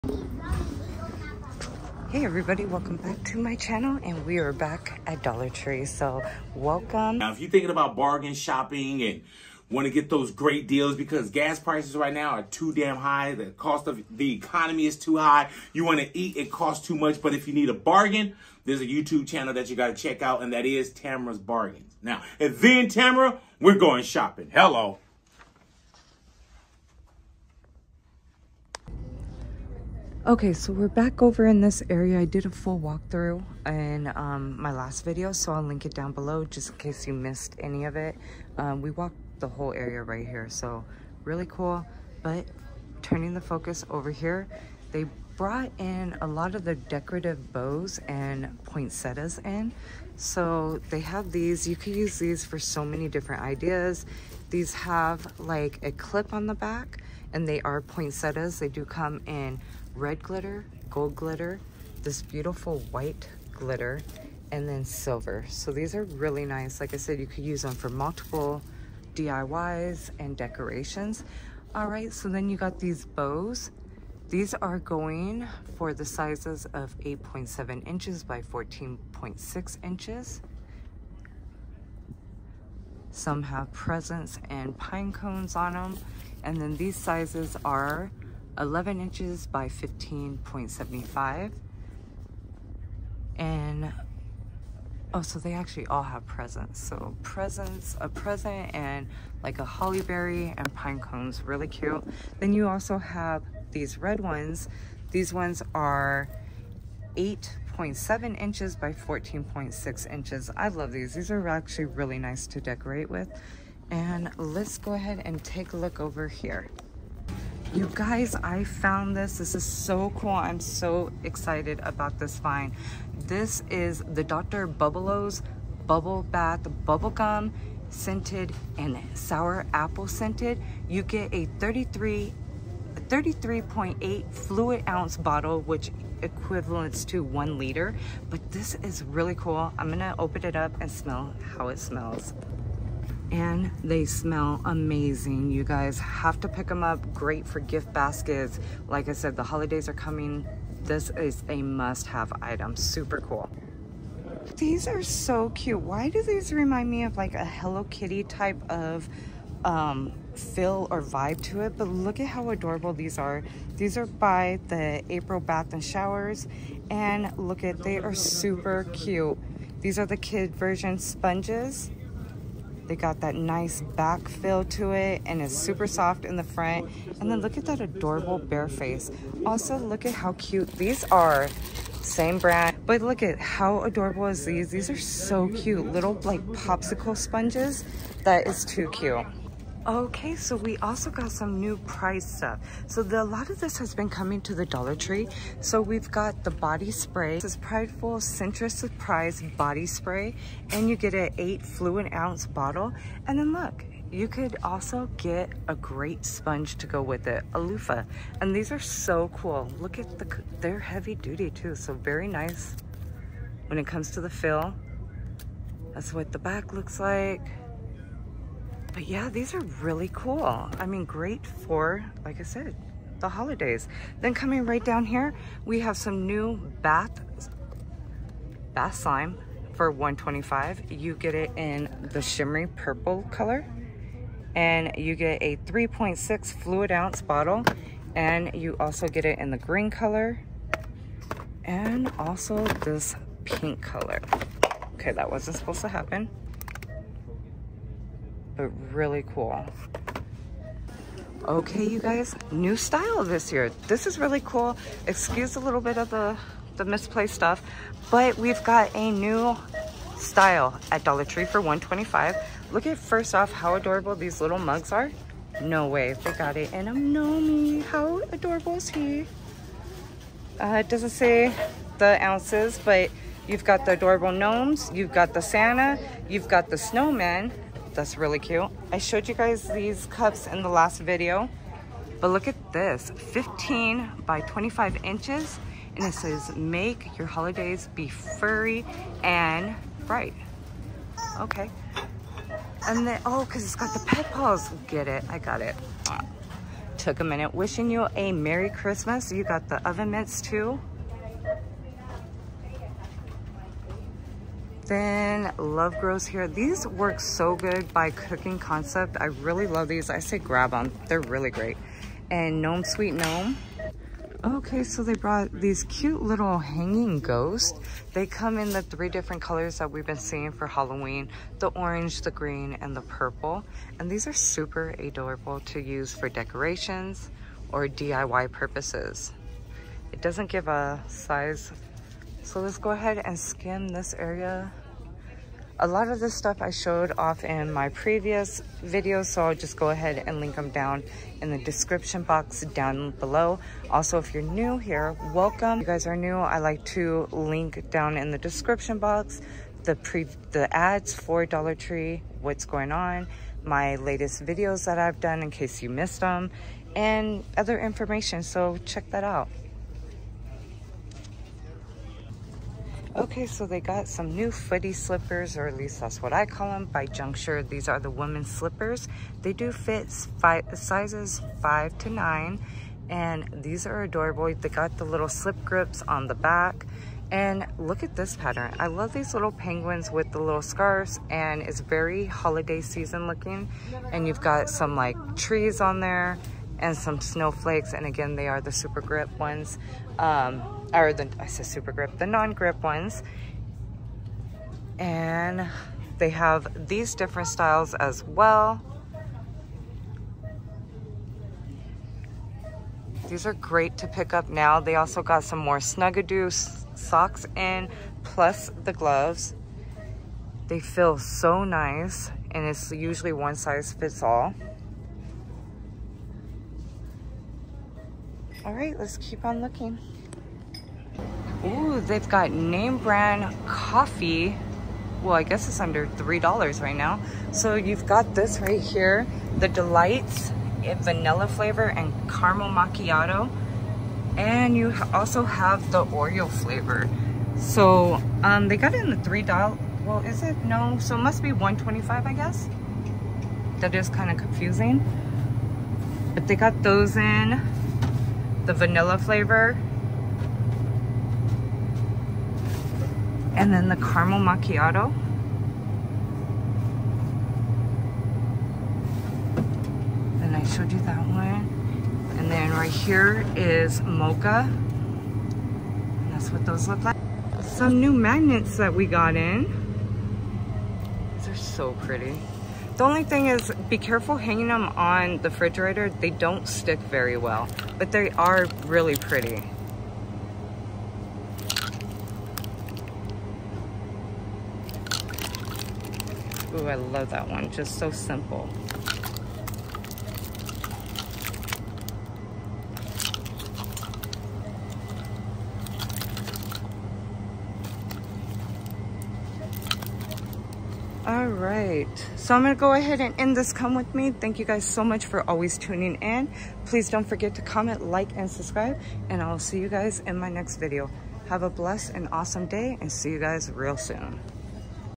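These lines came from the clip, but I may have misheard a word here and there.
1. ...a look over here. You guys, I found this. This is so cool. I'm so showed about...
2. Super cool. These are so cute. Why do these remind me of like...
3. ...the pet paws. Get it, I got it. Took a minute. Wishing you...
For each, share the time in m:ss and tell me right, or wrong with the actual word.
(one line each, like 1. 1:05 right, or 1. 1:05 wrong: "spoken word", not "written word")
1. 1:55 wrong: "excited", not "showed"
2. 2:32 right
3. 4:53 right.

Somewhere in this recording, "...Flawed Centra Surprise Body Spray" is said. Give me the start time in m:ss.
3:17.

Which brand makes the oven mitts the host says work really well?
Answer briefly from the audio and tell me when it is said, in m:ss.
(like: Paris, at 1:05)
Cooking Concept, at 5:08.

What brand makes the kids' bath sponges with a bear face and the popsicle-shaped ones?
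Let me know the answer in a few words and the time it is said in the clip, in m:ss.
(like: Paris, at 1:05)
April Bath and Showers, at 2:45.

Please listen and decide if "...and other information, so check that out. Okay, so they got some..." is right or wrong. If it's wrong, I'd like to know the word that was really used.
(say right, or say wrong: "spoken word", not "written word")
right.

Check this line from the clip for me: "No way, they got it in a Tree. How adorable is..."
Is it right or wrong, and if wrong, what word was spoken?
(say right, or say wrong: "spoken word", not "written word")
wrong: "Nomi", not "Tree".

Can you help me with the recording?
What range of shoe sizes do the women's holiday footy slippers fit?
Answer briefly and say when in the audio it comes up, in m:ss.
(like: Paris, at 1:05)
5 to 9, at 6:10.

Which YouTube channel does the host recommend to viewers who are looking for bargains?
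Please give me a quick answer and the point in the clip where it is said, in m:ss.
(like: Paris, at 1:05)
Tamara's Bargains, at 0:20.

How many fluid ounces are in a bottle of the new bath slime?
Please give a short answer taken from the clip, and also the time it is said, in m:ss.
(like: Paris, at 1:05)
3.6, at 3:55.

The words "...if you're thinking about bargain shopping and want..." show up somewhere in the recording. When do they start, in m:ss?
0:07.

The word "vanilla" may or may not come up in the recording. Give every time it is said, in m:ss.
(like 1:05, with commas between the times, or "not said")
7:11, 7:28.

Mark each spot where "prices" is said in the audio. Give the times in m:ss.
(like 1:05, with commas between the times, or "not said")
0:11, 3:11.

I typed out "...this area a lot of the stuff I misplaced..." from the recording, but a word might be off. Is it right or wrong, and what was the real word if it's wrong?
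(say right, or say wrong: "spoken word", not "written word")
wrong: "showed", not "misplaced".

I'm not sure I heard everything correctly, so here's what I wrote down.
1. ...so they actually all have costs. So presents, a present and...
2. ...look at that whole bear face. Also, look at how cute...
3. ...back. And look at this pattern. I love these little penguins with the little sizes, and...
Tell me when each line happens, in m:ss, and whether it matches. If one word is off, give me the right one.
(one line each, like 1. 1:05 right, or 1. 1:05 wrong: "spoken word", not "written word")
1. 1:35 wrong: "presents", not "costs"
2. 2:57 wrong: "adorable", not "whole"
3. 6:16 wrong: "scarves", not "sizes".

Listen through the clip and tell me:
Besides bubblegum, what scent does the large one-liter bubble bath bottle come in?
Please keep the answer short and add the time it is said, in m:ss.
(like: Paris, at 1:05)
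Sour apple, at 2:09.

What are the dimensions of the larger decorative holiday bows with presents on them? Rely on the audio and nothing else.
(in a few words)
11 inches by 15.75.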